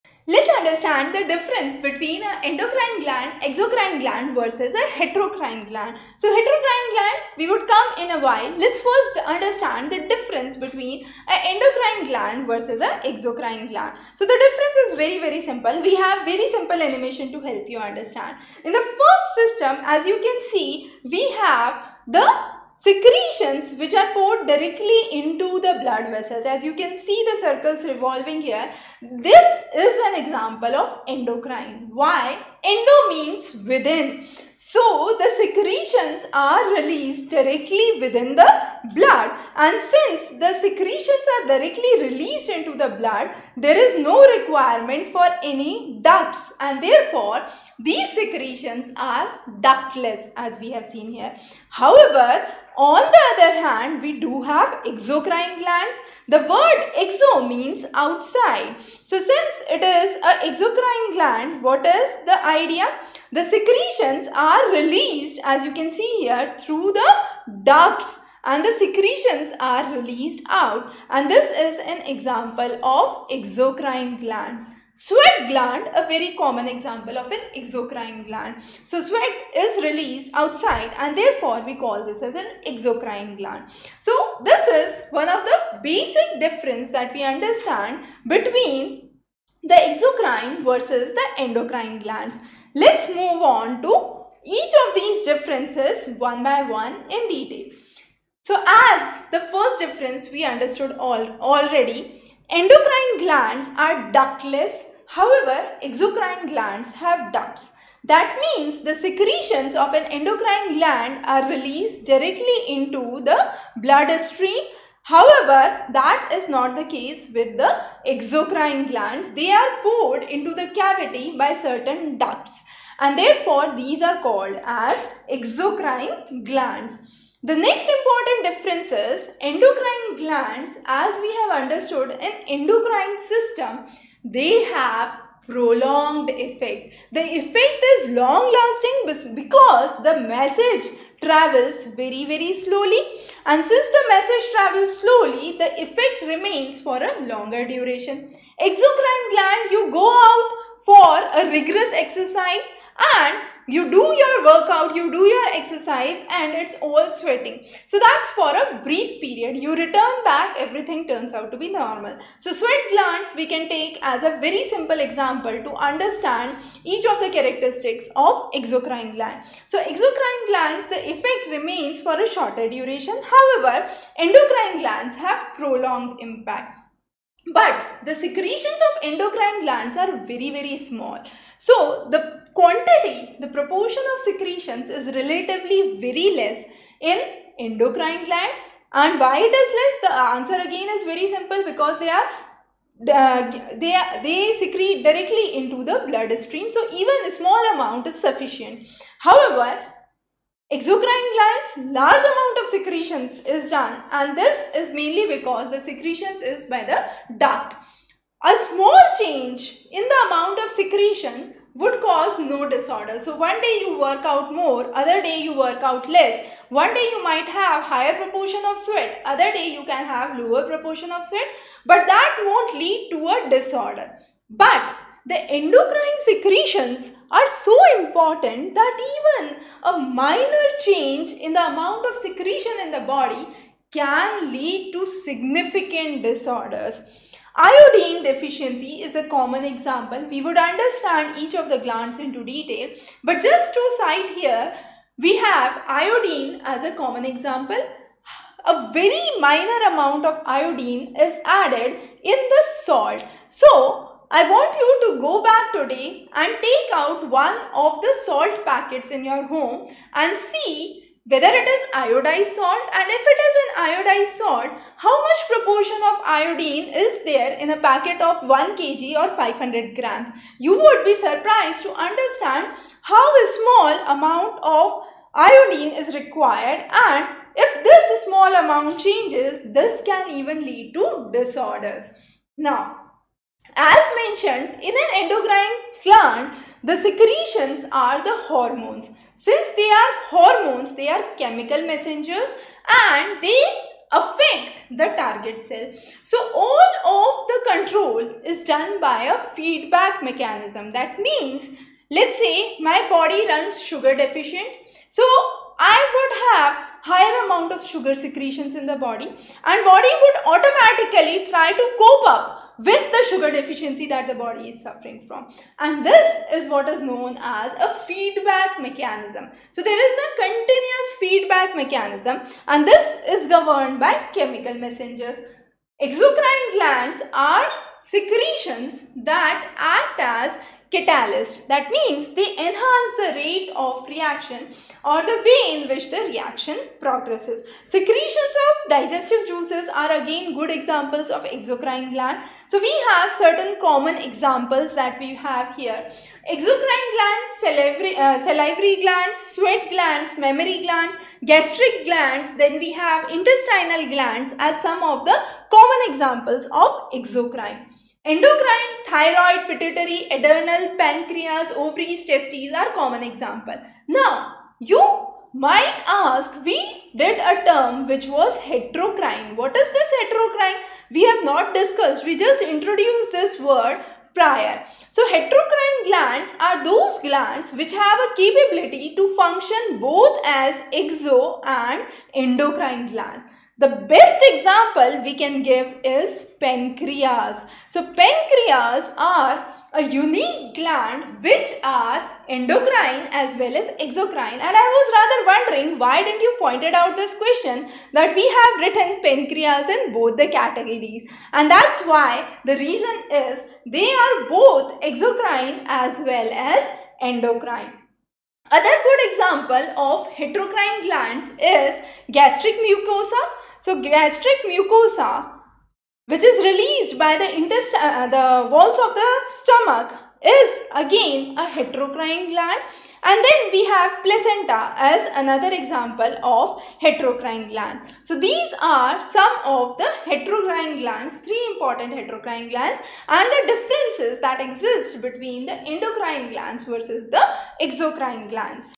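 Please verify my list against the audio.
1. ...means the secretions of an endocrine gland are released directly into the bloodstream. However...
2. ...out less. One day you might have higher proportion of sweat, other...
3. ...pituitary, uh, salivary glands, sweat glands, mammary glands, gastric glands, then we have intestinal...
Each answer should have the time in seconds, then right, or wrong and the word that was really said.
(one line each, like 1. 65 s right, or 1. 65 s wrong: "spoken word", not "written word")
1. 108 s right
2. 215 s right
3. 347 s wrong: "salivary", not "pituitary".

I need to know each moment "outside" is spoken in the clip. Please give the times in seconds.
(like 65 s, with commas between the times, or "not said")
57 s, 80 s.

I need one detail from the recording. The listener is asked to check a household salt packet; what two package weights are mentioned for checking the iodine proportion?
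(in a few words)
1 kg or 500 grams.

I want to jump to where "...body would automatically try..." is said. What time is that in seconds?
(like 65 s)
309 s.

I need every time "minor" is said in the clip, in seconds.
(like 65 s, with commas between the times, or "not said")
229 s, 249 s.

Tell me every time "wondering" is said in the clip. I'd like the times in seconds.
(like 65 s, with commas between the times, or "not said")
395 s.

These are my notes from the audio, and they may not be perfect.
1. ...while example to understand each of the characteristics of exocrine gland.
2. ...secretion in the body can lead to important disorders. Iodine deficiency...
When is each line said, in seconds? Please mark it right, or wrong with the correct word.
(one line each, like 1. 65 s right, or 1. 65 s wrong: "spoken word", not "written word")
1. 164 s wrong: "simple", not "while"
2. 232 s wrong: "significant", not "important".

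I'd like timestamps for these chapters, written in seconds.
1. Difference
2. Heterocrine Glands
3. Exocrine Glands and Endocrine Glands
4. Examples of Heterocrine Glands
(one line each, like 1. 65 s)
1. 22 s
2. 370 s
3. 111 s
4. 391 s.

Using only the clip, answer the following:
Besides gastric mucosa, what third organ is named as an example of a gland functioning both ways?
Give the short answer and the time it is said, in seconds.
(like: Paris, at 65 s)
Placenta, at 424 s.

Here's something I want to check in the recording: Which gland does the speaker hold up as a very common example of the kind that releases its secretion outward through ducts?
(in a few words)
Sweat gland.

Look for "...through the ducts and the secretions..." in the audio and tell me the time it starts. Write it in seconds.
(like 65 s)
66 s.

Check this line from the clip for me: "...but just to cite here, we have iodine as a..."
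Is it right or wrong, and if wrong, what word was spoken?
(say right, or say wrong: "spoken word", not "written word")
right.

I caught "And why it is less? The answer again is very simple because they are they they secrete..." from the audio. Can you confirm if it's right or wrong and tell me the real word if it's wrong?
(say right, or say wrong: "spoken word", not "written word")
right.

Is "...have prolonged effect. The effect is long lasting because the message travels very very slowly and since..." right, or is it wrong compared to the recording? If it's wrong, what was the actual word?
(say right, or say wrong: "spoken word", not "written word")
right.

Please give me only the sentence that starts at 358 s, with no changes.
Endocrine, thyroid, pituitary, adrenal, pancreas, ovaries, testes are common example.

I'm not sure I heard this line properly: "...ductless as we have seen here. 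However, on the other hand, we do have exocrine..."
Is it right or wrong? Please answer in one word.
right.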